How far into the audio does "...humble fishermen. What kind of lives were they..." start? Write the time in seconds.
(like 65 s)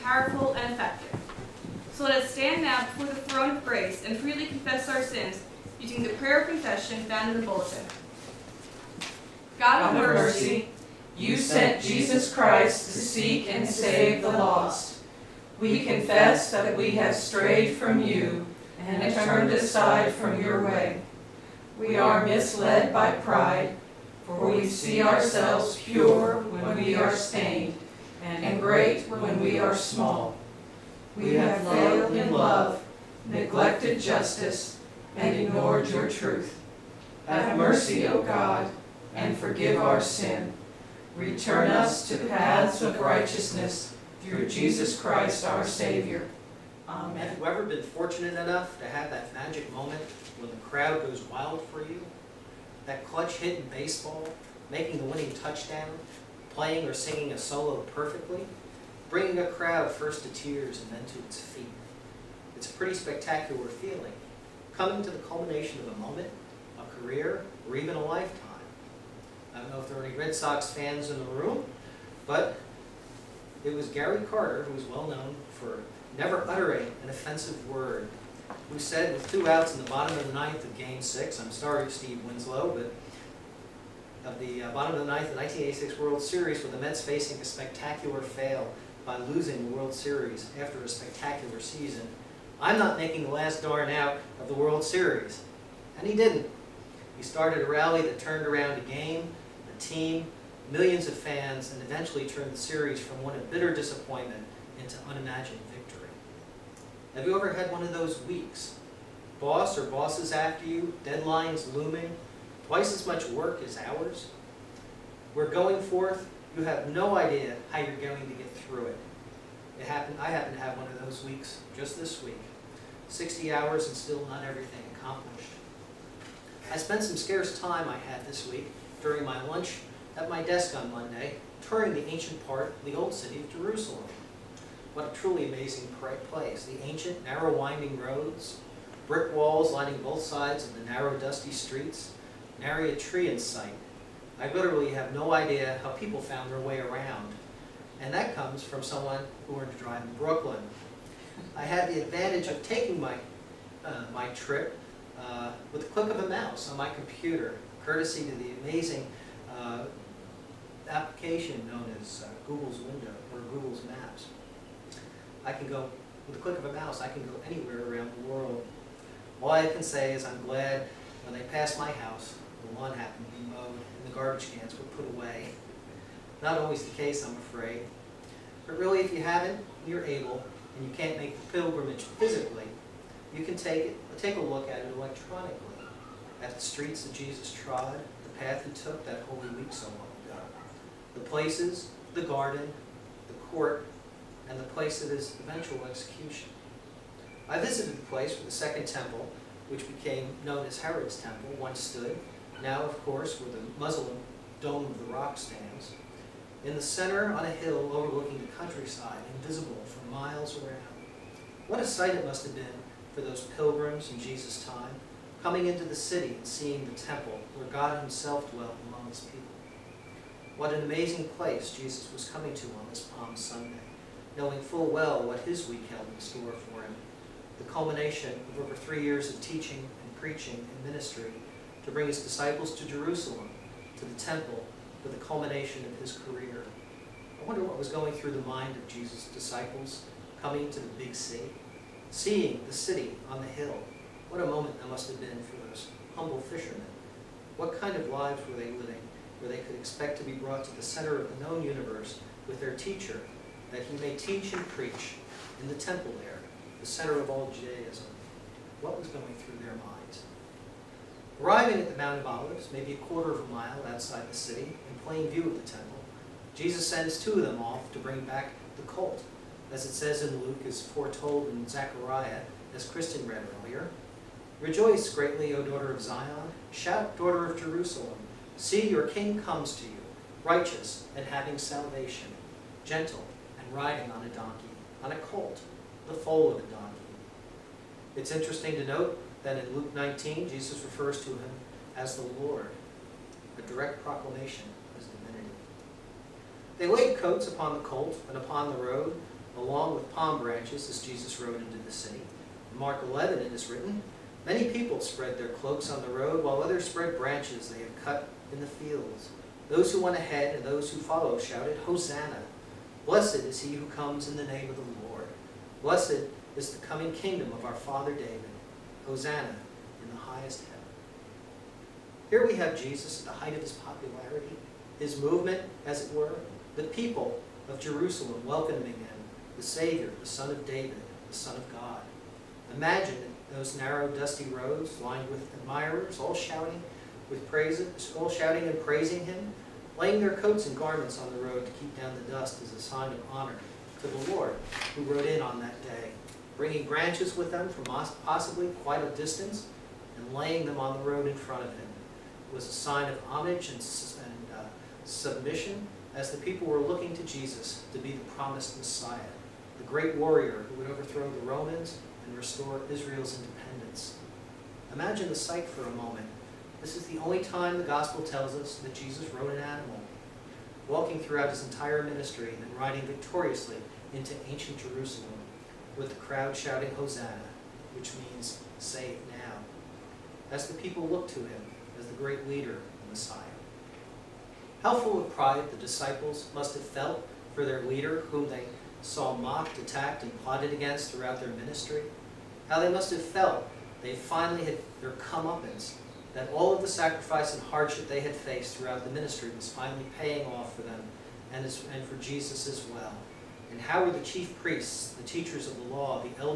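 246 s.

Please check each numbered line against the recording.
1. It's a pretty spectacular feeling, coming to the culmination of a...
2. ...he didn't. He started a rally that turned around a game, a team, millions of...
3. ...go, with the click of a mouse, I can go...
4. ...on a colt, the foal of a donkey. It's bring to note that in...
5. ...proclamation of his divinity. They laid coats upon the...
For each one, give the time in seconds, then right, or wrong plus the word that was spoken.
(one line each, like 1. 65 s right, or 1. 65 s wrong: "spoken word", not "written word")
1. 62 s right
2. 96 s right
3. 165 s right
4. 285 s wrong: "interesting", not "bring"
5. 294 s right.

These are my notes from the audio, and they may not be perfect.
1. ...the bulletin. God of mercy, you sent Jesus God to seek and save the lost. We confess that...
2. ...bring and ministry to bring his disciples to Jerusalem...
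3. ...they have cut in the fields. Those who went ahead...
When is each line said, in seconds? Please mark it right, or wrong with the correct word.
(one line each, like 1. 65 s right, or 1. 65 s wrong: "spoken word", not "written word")
1. 7 s wrong: "Christ", not "God"
2. 230 s wrong: "preaching", not "bring"
3. 307 s right.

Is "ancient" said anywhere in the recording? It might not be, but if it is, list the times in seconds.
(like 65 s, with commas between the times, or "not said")
132 s, 136 s, 374 s.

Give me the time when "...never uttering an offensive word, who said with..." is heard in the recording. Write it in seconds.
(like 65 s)
76 s.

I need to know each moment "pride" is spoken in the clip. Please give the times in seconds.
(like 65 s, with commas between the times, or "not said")
23 s, 385 s.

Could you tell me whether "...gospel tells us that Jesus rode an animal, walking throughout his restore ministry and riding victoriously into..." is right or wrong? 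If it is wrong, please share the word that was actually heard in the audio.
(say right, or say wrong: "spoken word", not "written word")
wrong: "entire", not "restore".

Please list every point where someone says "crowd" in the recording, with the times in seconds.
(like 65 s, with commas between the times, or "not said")
50 s, 59 s, 376 s.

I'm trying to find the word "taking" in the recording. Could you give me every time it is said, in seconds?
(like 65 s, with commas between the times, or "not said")
152 s.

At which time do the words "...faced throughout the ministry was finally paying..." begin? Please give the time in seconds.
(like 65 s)
398 s.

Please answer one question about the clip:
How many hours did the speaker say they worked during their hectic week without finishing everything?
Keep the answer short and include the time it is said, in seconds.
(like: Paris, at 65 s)
60, at 123 s.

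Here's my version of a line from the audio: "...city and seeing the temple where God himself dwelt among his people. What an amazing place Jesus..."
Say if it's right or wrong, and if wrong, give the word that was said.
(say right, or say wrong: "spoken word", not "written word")
right.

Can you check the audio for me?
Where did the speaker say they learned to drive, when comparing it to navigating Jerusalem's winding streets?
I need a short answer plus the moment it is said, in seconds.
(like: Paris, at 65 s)
Brooklyn, at 150 s.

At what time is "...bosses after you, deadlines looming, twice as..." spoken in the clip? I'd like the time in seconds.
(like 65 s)
109 s.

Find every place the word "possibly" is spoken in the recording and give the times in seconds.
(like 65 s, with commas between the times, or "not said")
348 s.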